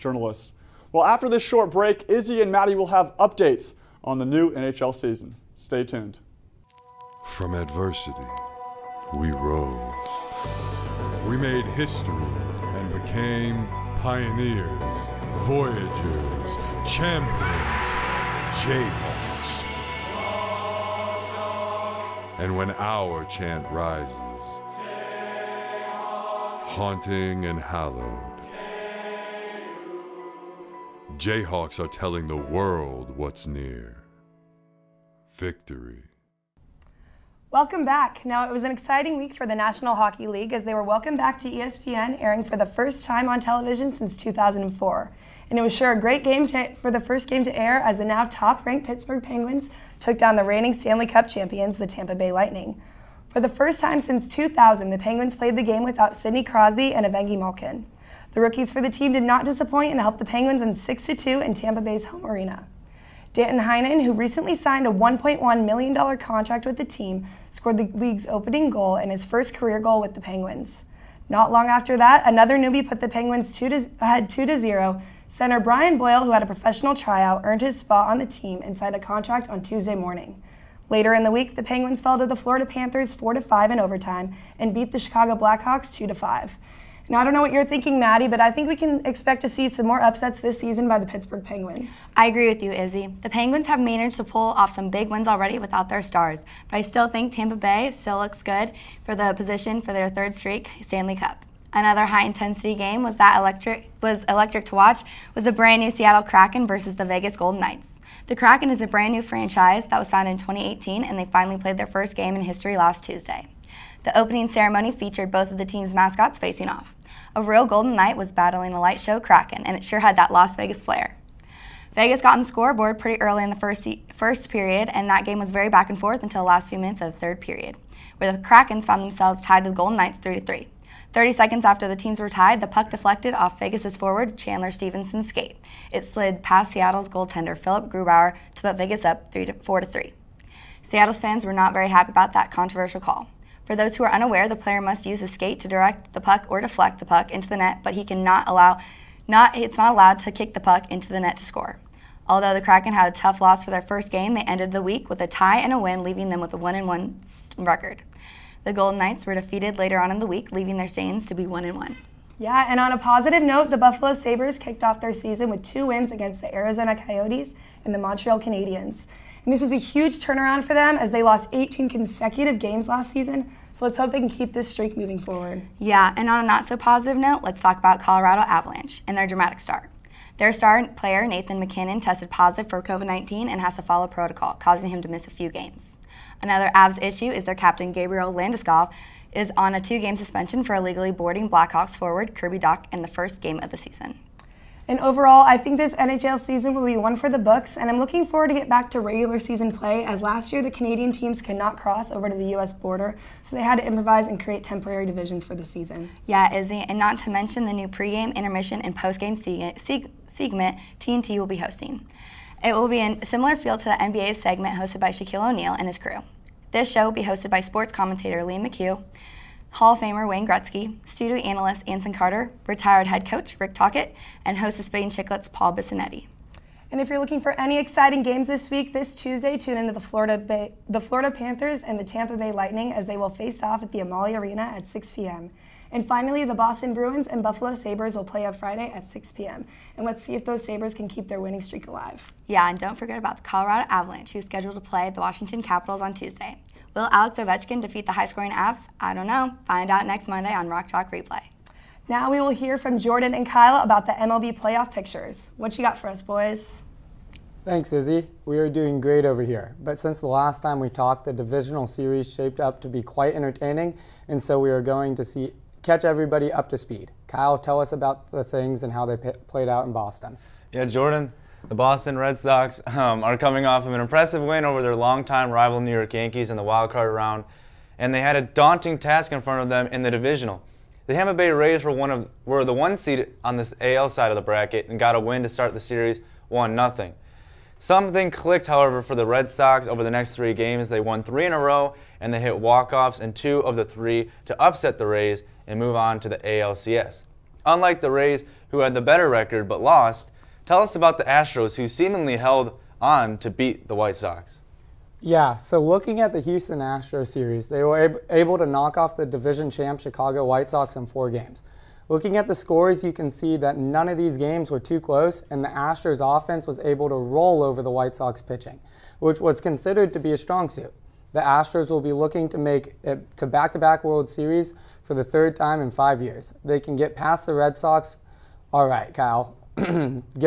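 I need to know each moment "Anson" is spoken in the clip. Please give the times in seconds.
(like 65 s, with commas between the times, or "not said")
221 s.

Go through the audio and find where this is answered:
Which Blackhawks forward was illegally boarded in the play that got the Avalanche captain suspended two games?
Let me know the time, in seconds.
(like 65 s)
192 s.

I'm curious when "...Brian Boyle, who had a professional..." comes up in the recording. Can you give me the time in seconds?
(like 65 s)
75 s.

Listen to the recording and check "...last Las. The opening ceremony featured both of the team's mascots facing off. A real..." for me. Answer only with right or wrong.
wrong.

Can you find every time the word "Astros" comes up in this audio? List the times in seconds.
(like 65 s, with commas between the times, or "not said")
301 s, 306 s, 315 s, 321 s.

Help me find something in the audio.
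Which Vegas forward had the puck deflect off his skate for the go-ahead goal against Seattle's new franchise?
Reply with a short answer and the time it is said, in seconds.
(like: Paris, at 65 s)
Chandler Stephenson, at 134 s.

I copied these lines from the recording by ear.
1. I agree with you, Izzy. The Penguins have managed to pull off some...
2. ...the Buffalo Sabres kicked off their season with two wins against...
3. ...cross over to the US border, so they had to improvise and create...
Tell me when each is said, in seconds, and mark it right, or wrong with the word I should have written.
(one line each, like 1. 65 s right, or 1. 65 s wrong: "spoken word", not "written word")
1. 92 s right
2. 163 s right
3. 201 s right.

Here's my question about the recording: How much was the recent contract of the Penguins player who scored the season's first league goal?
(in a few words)
$1.1 million.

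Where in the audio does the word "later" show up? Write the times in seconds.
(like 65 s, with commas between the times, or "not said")
80 s, 159 s.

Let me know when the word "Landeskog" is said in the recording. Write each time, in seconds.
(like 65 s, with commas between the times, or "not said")
188 s.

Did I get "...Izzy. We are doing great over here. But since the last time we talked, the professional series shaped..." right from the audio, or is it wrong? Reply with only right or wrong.
wrong.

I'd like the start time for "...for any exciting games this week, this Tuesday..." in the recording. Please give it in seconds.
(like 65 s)
227 s.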